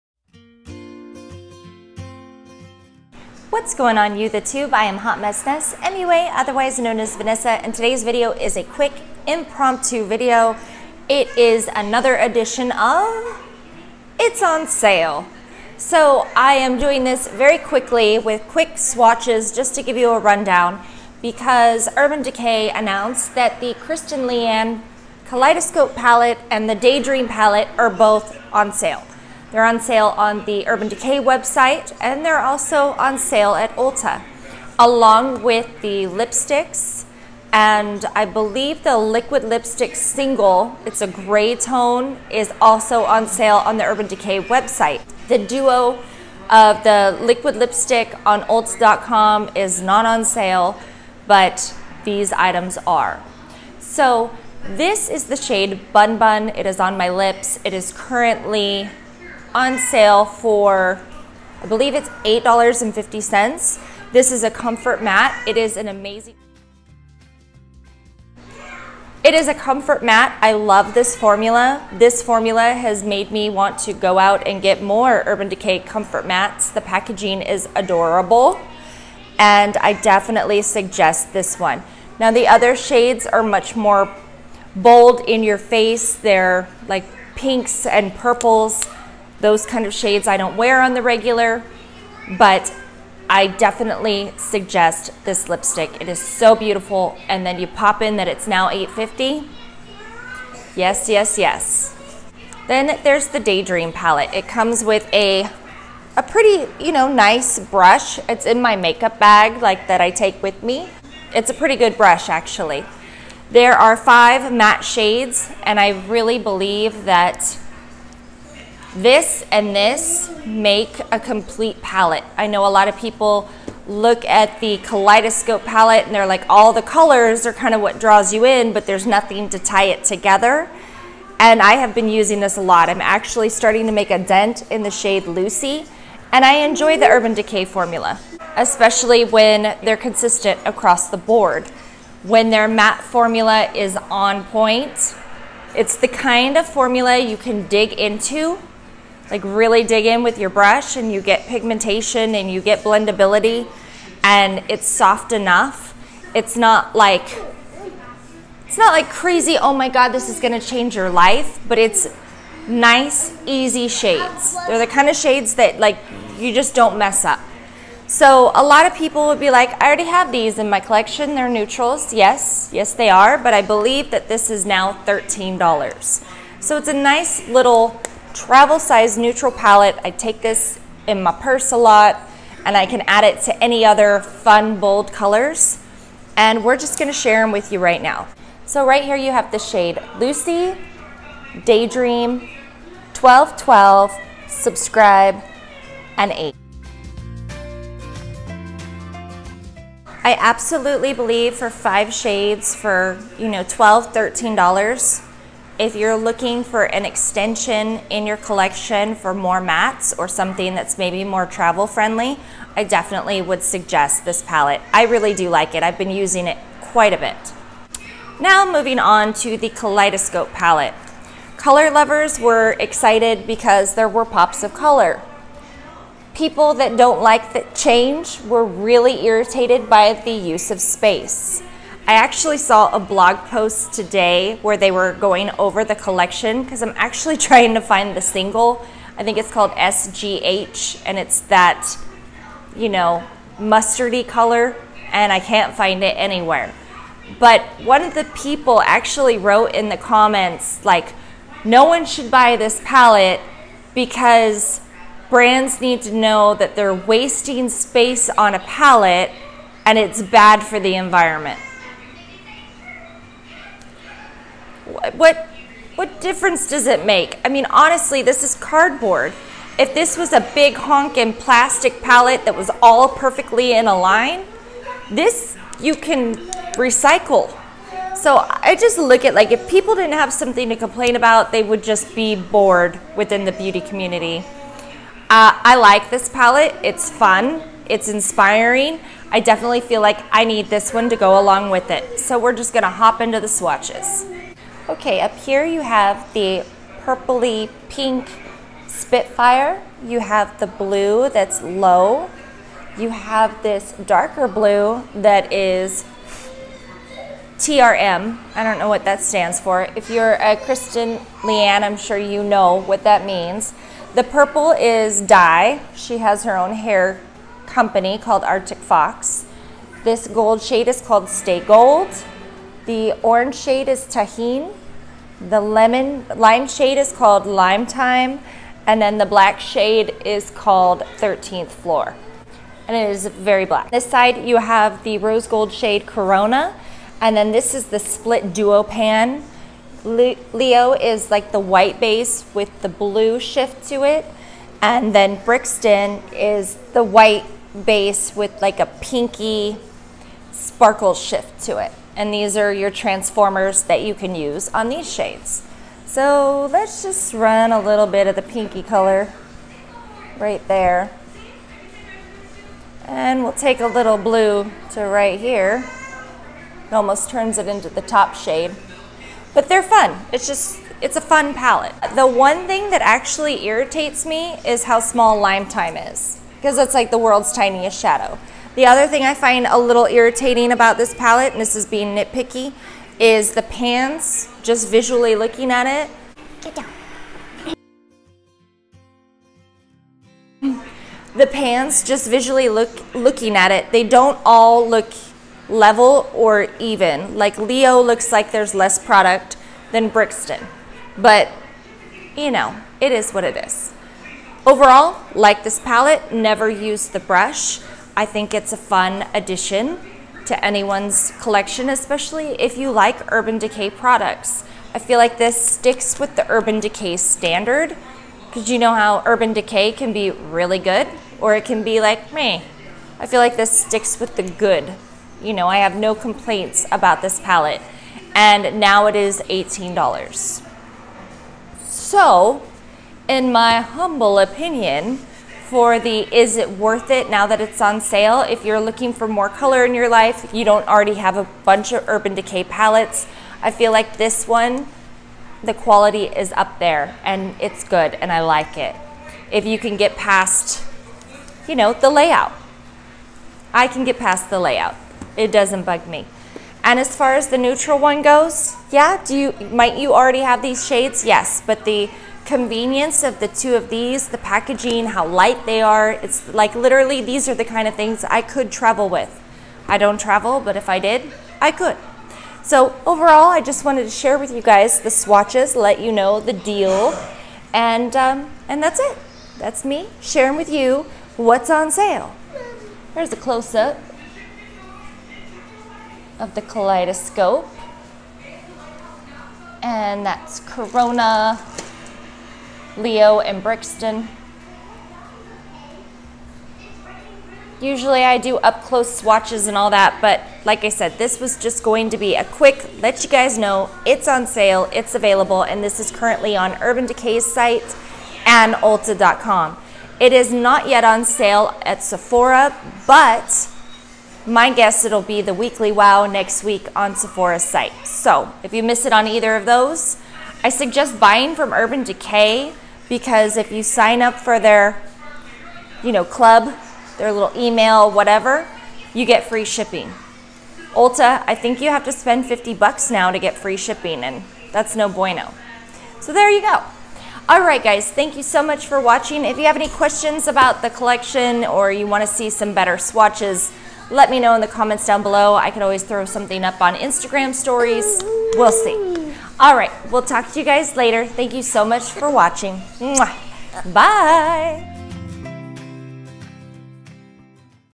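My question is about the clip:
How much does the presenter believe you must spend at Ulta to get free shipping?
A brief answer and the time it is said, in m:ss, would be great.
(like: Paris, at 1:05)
$50, at 8:52.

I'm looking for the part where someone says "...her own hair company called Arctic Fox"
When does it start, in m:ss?
5:16.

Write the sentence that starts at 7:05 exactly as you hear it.
You know, I have no complaints about this palette.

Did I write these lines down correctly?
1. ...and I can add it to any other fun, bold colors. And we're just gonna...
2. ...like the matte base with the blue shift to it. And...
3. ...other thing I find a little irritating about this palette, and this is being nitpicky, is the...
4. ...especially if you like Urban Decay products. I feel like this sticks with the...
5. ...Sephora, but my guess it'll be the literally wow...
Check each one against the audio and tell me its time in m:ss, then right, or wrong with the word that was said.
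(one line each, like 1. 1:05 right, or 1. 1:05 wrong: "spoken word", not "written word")
1. 3:02 right
2. 5:41 wrong: "white", not "matte"
3. 6:18 right
4. 6:51 right
5. 8:32 wrong: "weekly", not "literally".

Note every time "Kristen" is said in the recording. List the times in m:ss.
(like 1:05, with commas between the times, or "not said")
0:23, 5:10.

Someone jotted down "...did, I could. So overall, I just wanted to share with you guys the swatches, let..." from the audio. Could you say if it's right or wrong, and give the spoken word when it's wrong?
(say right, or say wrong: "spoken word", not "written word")
right.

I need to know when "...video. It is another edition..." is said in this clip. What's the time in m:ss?
0:10.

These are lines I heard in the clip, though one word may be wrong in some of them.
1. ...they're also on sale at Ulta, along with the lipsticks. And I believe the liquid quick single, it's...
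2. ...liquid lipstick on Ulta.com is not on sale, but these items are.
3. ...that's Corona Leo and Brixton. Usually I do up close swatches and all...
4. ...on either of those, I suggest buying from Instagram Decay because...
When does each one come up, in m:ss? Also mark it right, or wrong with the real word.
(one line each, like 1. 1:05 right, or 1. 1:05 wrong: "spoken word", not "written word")
1. 0:32 wrong: "lipstick", not "quick"
2. 0:47 right
3. 8:10 right
4. 8:39 wrong: "Urban", not "Instagram".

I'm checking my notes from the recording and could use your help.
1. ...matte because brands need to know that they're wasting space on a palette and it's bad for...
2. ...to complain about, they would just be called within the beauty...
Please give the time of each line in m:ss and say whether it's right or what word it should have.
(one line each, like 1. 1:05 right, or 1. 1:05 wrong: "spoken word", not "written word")
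1. 4:12 wrong: "palette", not "matte"
2. 4:40 wrong: "bored", not "called".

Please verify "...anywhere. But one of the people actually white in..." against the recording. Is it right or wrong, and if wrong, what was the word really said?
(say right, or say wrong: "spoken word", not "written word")
wrong: "wrote", not "white".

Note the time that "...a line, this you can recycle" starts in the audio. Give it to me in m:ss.
4:33.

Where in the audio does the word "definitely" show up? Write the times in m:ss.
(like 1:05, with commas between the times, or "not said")
1:19, 1:33, 3:32, 4:49.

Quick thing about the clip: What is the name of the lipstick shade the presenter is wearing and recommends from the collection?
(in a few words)
Bun Bun.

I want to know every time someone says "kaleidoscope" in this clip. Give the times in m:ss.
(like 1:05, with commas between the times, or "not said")
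0:25, 2:04, 3:39, 8:06.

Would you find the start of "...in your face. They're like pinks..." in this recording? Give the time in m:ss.
1:25.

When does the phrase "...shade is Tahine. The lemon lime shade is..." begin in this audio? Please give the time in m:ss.
5:23.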